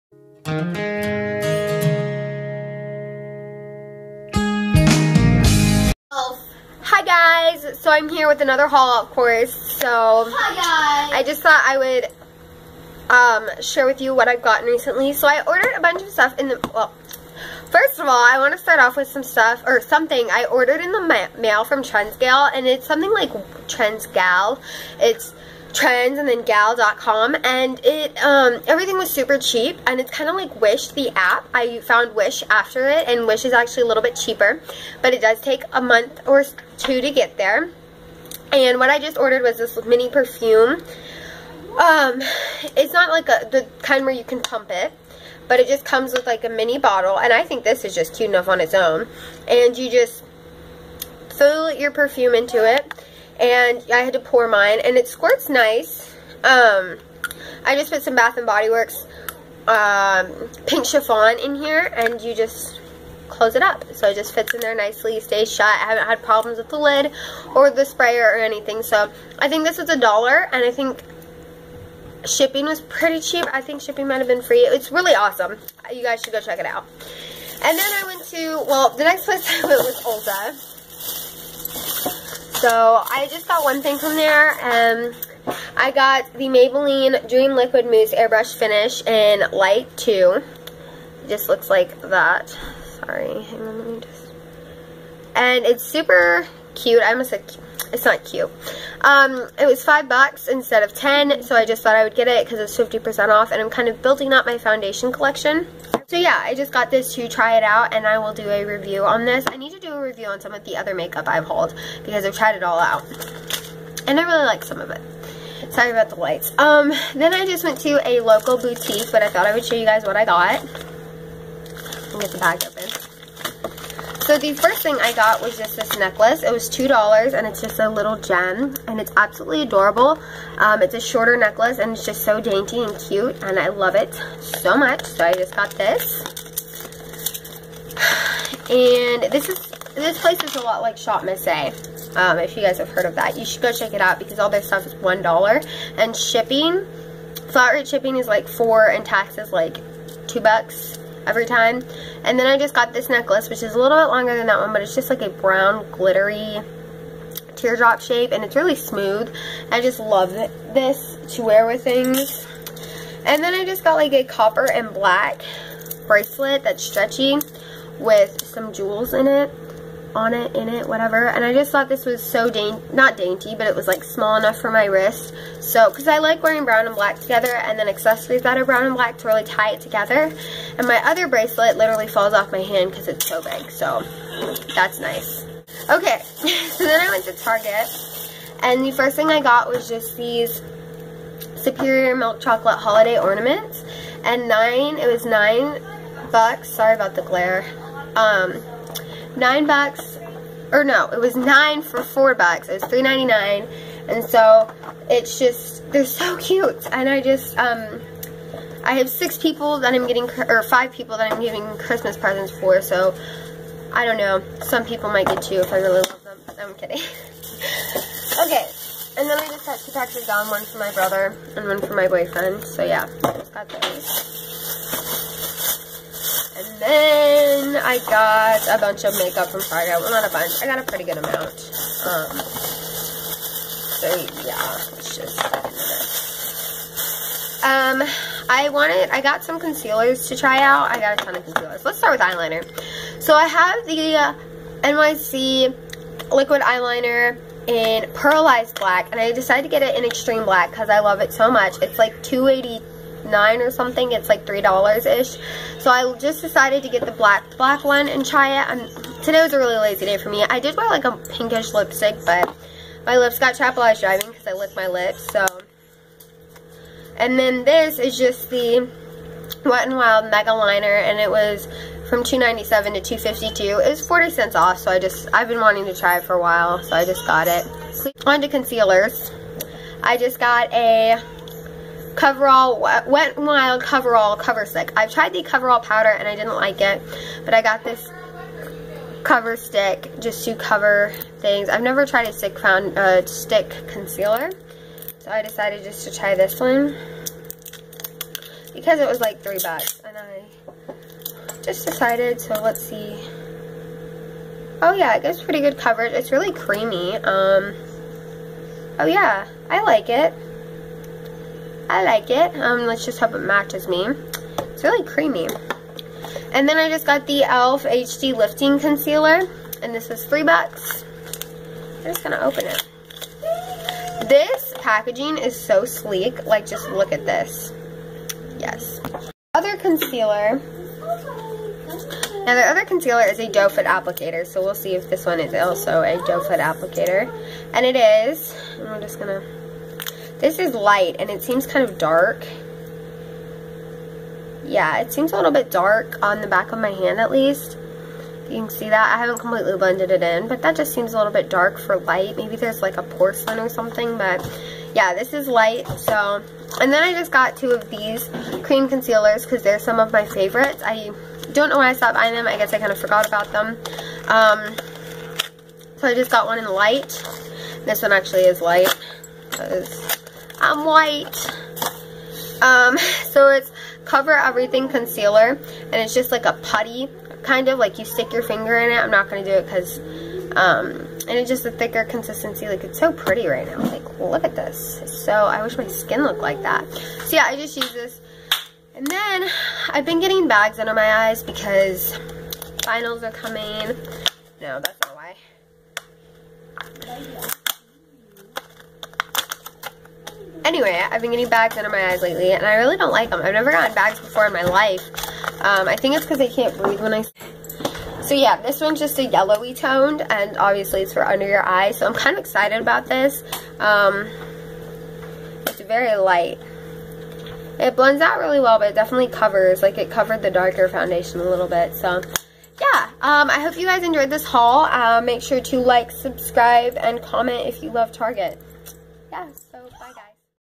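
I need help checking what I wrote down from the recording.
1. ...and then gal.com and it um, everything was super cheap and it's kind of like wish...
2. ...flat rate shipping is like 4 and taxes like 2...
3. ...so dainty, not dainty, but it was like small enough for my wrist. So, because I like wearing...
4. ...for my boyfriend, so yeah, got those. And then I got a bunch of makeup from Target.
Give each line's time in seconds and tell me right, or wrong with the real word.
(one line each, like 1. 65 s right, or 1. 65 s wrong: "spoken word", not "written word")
1. 26 s right
2. 147 s right
3. 172 s right
4. 221 s right.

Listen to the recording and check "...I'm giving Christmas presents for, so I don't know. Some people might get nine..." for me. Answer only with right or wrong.
wrong.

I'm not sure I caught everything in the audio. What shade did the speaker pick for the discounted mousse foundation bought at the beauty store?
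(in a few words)
Light 2.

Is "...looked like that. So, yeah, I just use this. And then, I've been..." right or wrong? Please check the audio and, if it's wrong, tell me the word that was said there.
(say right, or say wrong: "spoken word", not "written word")
right.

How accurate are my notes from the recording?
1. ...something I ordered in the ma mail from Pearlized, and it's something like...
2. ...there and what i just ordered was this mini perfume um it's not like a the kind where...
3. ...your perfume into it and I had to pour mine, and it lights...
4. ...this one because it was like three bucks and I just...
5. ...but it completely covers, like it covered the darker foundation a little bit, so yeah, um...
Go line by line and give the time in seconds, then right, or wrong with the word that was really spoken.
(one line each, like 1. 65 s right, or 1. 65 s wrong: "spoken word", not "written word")
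1. 19 s wrong: "Trendsgal", not "Pearlized"
2. 37 s right
3. 51 s wrong: "squirts", not "lights"
4. 296 s right
5. 418 s wrong: "definitely", not "completely".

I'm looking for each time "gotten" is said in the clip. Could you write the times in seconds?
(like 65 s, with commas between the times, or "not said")
14 s, 403 s.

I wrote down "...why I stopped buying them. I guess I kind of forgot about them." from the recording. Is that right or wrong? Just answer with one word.
right.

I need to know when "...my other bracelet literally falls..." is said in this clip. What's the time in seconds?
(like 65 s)
180 s.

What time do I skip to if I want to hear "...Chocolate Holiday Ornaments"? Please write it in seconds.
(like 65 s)
192 s.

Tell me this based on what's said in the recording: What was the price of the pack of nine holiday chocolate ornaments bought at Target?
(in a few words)
$3.99.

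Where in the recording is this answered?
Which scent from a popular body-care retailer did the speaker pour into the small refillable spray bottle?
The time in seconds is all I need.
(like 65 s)
60 s.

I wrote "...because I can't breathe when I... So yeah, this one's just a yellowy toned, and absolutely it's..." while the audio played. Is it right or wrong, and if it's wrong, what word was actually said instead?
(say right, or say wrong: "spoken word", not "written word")
wrong: "obviously", not "absolutely".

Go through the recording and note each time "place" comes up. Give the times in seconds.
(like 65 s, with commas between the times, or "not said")
79 s, 140 s.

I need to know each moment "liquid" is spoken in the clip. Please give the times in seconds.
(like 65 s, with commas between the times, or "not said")
87 s, 246 s.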